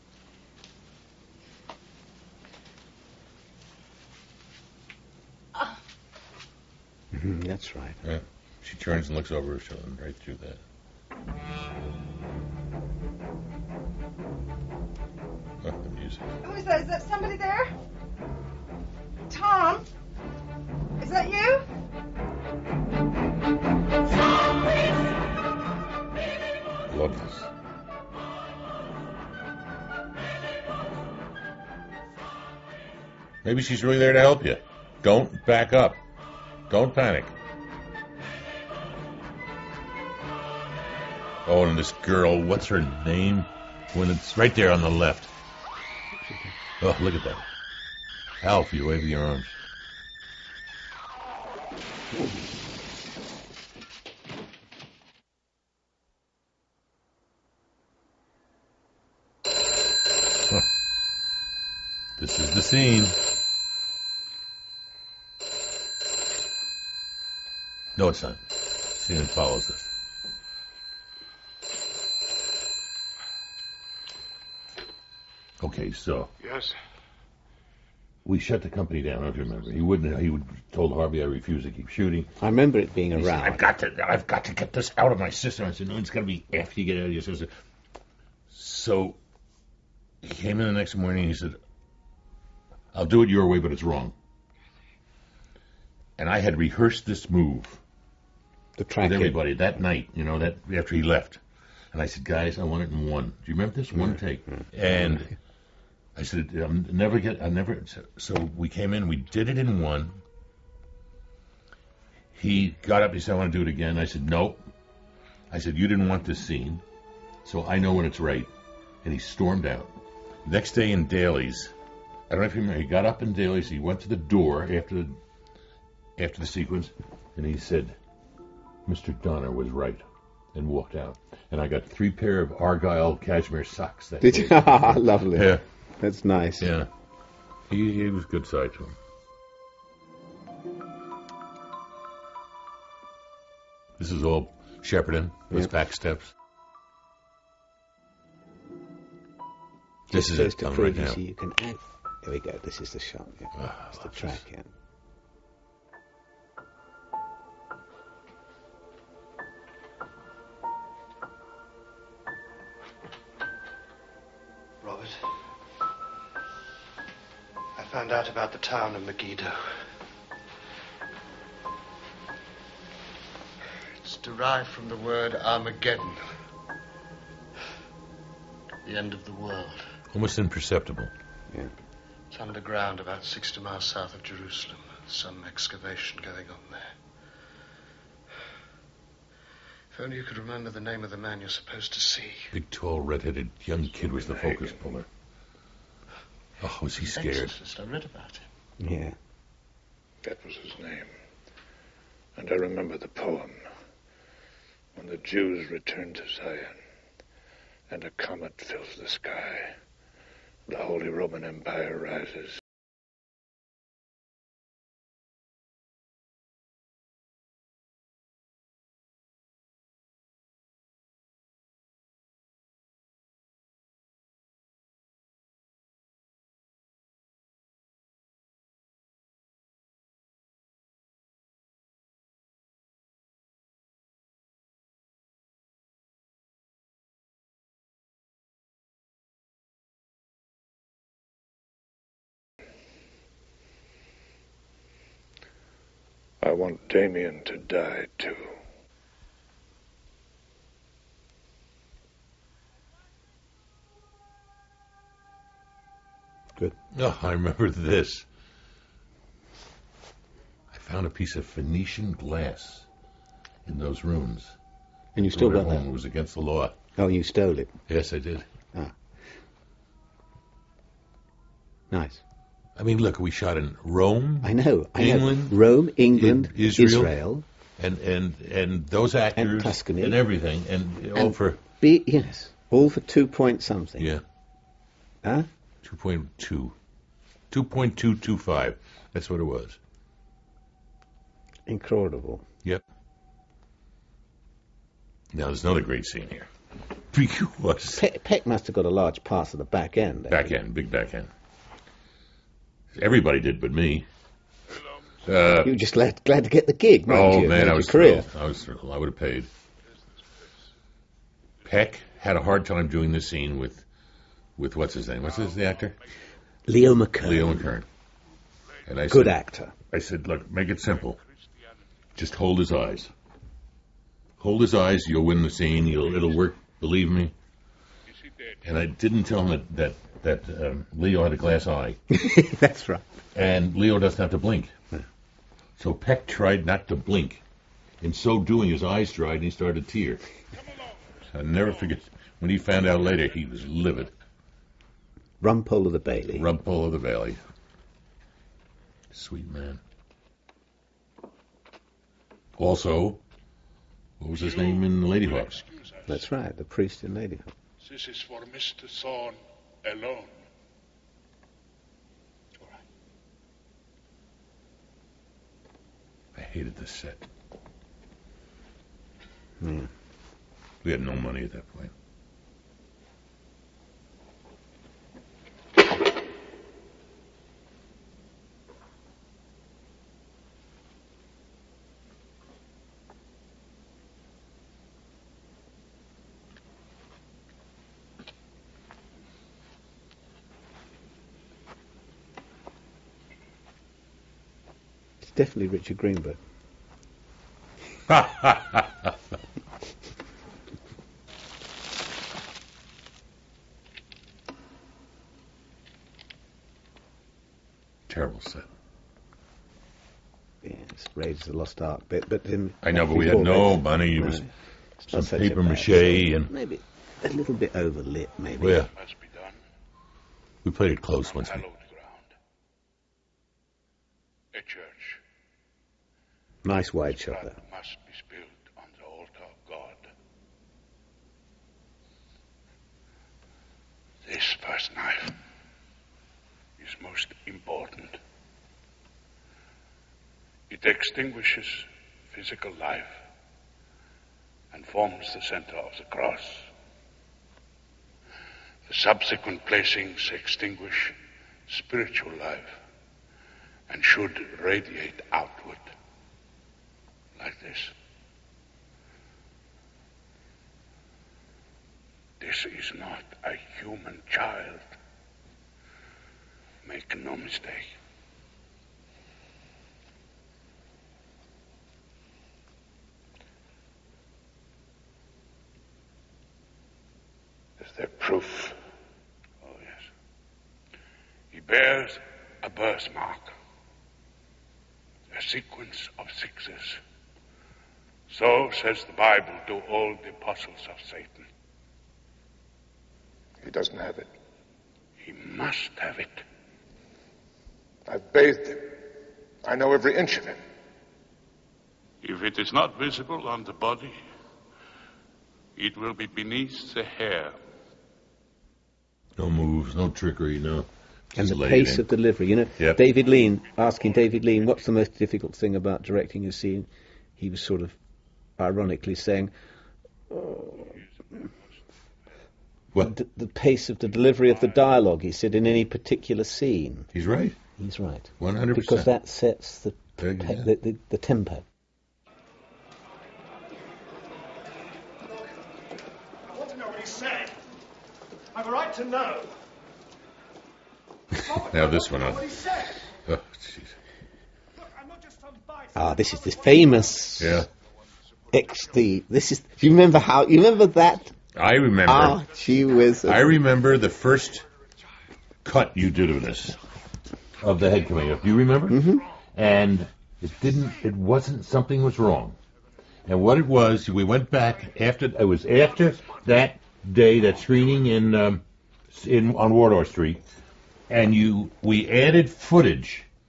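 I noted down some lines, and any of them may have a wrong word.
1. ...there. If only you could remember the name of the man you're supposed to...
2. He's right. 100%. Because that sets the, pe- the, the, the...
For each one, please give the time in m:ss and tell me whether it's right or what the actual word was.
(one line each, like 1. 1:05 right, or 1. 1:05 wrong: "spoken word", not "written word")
1. 3:06 right
2. 8:47 right.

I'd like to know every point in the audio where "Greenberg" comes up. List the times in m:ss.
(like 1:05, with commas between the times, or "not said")
6:35.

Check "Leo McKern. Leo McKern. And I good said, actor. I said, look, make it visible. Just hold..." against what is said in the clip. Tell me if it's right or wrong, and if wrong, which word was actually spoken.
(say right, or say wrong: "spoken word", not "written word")
wrong: "simple", not "visible".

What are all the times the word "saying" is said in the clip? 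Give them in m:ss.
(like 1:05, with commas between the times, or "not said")
8:39, 8:57.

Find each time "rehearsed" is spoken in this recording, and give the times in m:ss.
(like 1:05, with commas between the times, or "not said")
1:36.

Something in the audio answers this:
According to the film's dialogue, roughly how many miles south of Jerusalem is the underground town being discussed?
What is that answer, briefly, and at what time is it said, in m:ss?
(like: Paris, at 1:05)
60, at 3:03.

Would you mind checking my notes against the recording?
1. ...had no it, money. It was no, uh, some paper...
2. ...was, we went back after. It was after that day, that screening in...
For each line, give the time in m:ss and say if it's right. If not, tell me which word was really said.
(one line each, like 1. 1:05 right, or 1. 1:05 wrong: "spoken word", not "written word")
1. 6:53 right
2. 9:23 right.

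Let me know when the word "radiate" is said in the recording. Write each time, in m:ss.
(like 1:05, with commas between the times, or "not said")
7:34.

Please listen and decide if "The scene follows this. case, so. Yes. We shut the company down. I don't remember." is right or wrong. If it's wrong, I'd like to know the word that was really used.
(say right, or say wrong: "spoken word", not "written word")
right.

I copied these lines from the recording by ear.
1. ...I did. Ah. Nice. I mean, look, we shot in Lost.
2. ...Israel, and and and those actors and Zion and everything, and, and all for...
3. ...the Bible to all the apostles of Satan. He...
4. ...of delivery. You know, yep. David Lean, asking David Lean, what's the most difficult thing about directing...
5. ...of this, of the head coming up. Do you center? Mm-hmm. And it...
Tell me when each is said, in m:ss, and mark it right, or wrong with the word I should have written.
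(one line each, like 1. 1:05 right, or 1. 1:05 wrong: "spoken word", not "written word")
1. 4:28 wrong: "Rome", not "Lost"
2. 4:36 wrong: "Tuscany", not "Zion"
3. 8:09 right
4. 8:31 right
5. 9:16 wrong: "remember", not "center".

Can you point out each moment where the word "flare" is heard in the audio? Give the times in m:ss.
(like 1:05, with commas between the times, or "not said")
not said.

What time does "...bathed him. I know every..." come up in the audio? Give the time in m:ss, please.
8:18.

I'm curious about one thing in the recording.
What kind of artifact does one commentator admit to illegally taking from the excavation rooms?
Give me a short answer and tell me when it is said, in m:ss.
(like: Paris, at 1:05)
Phoenician glass, at 4:21.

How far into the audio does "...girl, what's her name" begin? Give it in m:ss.
0:42.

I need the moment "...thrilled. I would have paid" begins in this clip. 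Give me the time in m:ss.
5:08.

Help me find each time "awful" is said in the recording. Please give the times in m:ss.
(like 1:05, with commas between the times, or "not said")
not said.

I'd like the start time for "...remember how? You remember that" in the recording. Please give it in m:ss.
9:09.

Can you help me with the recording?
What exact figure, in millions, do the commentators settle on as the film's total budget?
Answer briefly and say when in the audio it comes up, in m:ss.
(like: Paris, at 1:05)
2.225, at 4:47.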